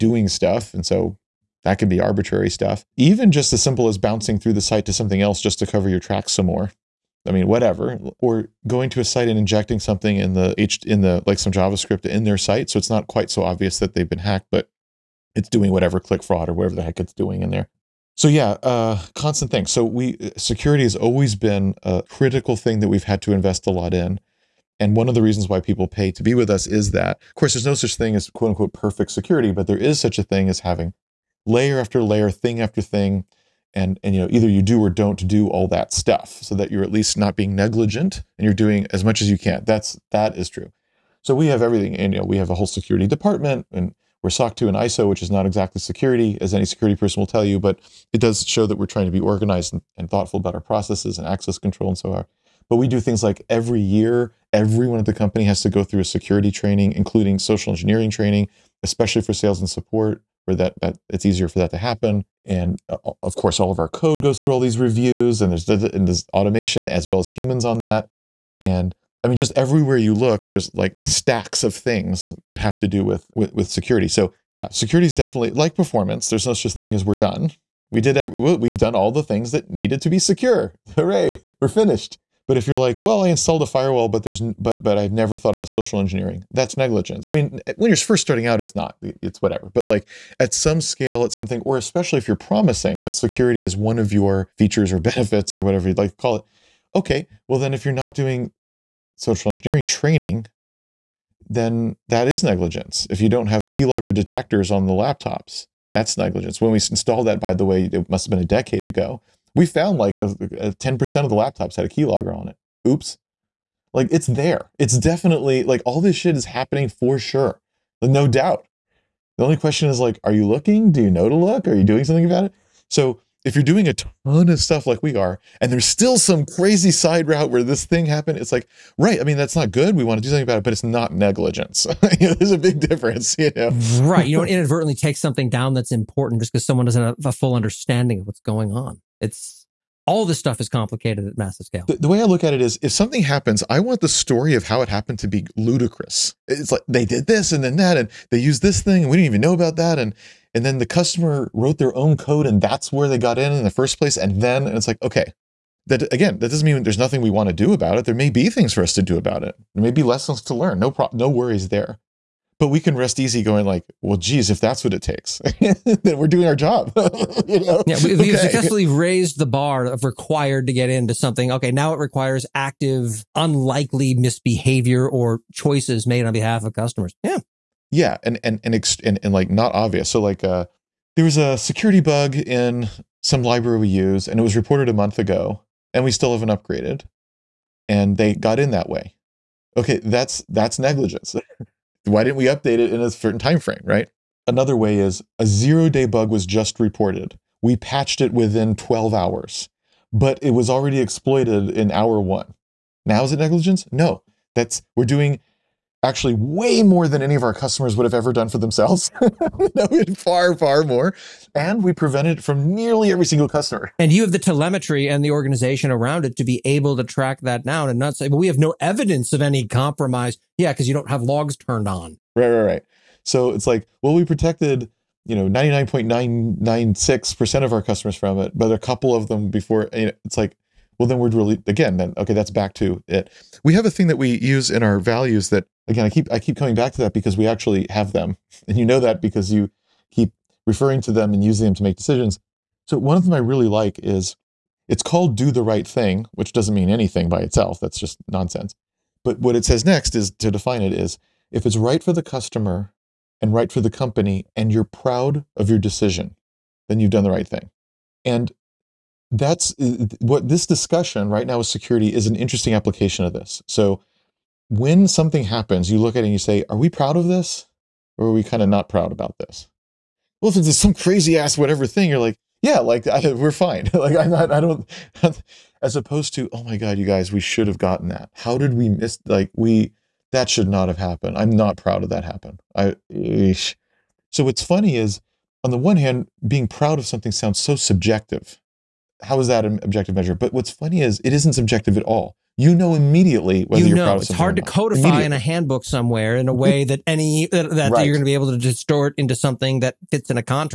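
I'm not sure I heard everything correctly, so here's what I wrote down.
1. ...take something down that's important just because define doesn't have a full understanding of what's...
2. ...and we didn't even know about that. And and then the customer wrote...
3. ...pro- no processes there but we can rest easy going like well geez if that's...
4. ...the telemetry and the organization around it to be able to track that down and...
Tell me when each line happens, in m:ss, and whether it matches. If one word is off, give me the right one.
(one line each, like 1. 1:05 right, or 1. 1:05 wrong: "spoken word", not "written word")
1. 2:14 wrong: "someone", not "define"
2. 2:29 right
3. 2:40 wrong: "worries", not "processes"
4. 3:34 right.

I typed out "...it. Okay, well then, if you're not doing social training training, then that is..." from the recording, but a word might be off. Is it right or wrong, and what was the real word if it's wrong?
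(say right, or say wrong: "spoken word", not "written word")
wrong: "engineering", not "training".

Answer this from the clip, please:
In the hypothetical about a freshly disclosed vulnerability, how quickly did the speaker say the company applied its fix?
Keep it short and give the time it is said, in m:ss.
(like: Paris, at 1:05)
12 hours, at 3:18.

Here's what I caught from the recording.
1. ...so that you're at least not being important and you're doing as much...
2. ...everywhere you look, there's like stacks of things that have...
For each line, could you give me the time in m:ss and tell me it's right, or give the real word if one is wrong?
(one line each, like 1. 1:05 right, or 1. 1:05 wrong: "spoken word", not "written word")
1. 0:36 wrong: "negligent", not "important"
2. 1:09 right.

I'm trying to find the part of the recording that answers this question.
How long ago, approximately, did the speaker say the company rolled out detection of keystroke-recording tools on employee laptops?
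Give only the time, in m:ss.
1:48.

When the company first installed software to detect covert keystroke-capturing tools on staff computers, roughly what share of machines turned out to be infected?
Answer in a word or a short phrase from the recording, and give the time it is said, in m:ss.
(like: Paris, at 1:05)
10%, at 1:50.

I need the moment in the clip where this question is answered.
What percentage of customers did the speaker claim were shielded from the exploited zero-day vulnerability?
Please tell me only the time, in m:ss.
3:45.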